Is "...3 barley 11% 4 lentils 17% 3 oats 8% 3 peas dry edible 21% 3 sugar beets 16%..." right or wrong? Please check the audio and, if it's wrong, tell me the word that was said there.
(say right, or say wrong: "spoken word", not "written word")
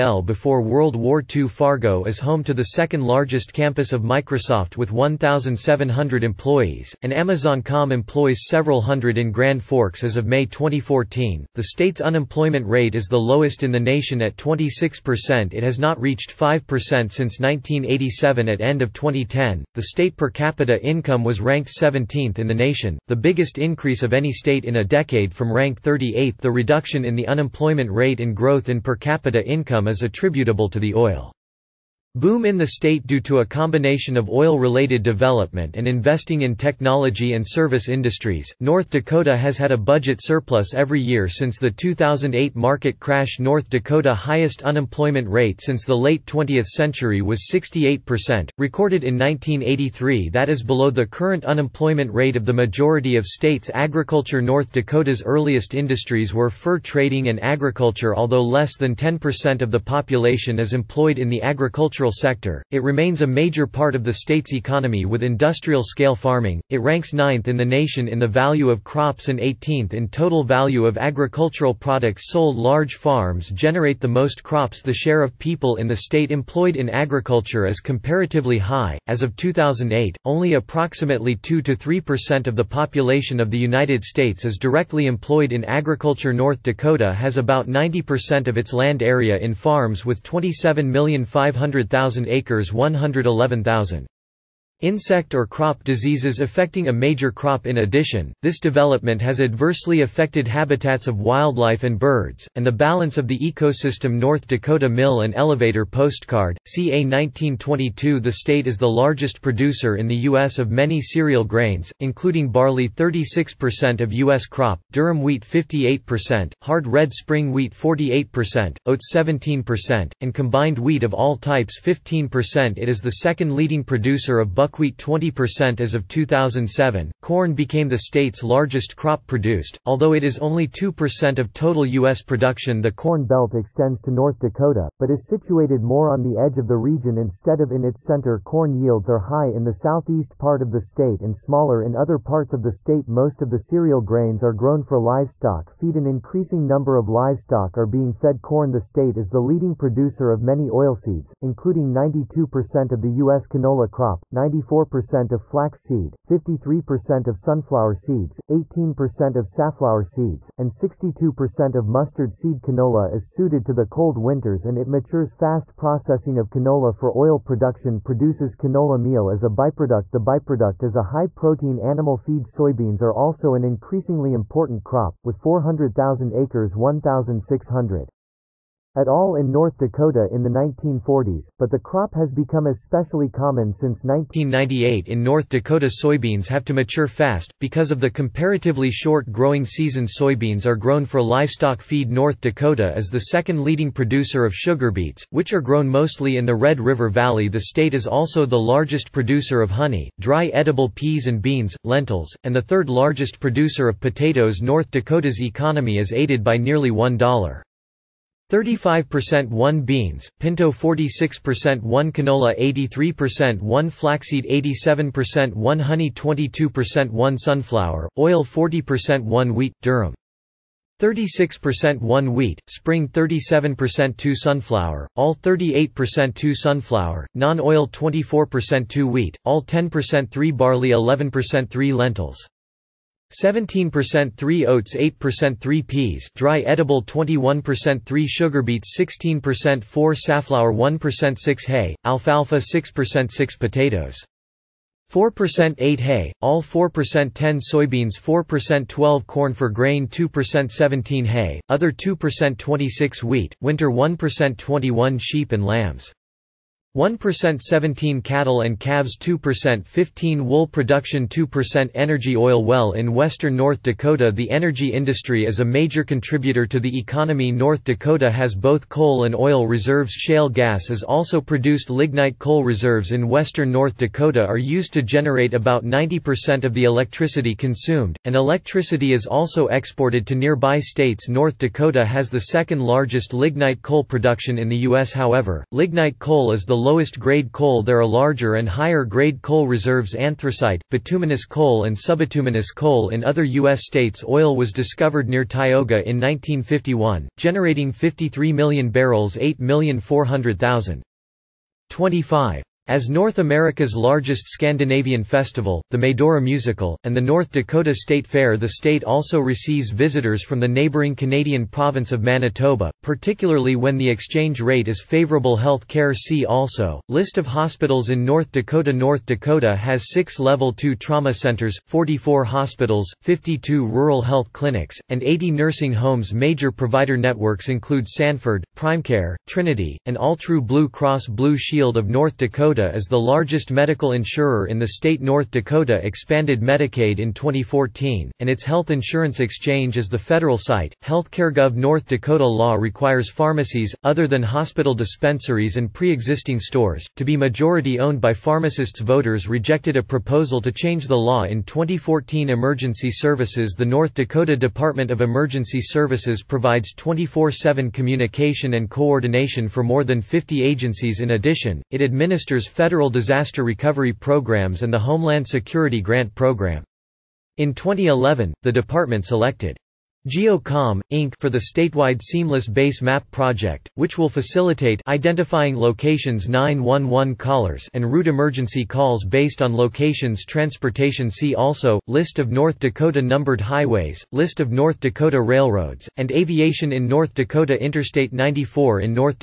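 wrong: "3", not "4".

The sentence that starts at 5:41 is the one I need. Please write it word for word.
HealthcareGov North Dakota law requires pharmacies, other than hospital dispensaries and pre existing stores, to be majority owned by pharmacists.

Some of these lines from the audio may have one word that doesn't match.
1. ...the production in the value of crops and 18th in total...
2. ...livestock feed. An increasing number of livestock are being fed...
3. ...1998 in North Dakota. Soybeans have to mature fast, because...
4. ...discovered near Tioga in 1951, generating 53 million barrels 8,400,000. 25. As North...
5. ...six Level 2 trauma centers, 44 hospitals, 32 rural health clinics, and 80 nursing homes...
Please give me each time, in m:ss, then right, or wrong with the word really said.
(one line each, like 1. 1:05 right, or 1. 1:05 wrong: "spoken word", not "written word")
1. 1:07 wrong: "nation", not "production"
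2. 2:24 right
3. 3:04 right
4. 4:54 right
5. 5:20 wrong: "52", not "32".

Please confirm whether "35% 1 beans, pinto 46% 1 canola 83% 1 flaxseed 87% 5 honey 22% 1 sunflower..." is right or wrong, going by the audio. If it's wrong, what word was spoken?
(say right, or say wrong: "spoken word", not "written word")
wrong: "1", not "5".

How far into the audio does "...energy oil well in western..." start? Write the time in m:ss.
4:21.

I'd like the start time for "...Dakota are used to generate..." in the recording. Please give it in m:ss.
4:33.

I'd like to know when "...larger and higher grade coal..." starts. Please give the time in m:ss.
4:48.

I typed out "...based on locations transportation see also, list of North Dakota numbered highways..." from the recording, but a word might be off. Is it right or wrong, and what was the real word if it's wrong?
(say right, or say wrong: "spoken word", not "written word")
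right.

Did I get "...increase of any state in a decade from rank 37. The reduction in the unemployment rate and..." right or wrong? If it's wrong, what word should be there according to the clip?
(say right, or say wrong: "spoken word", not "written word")
wrong: "38", not "37".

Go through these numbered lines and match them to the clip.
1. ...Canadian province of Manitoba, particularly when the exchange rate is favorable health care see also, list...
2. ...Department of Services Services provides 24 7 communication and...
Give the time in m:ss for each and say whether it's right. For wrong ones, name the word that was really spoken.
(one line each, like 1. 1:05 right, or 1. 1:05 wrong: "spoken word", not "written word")
1. 5:11 right
2. 5:54 wrong: "Emergency", not "Services".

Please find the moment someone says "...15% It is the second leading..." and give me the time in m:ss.
2:01.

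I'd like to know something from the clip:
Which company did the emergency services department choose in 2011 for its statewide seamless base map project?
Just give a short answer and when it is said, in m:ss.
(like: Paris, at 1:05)
GeoComm, Inc., at 6:10.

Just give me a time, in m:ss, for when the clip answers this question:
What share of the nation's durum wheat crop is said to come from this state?
1:55.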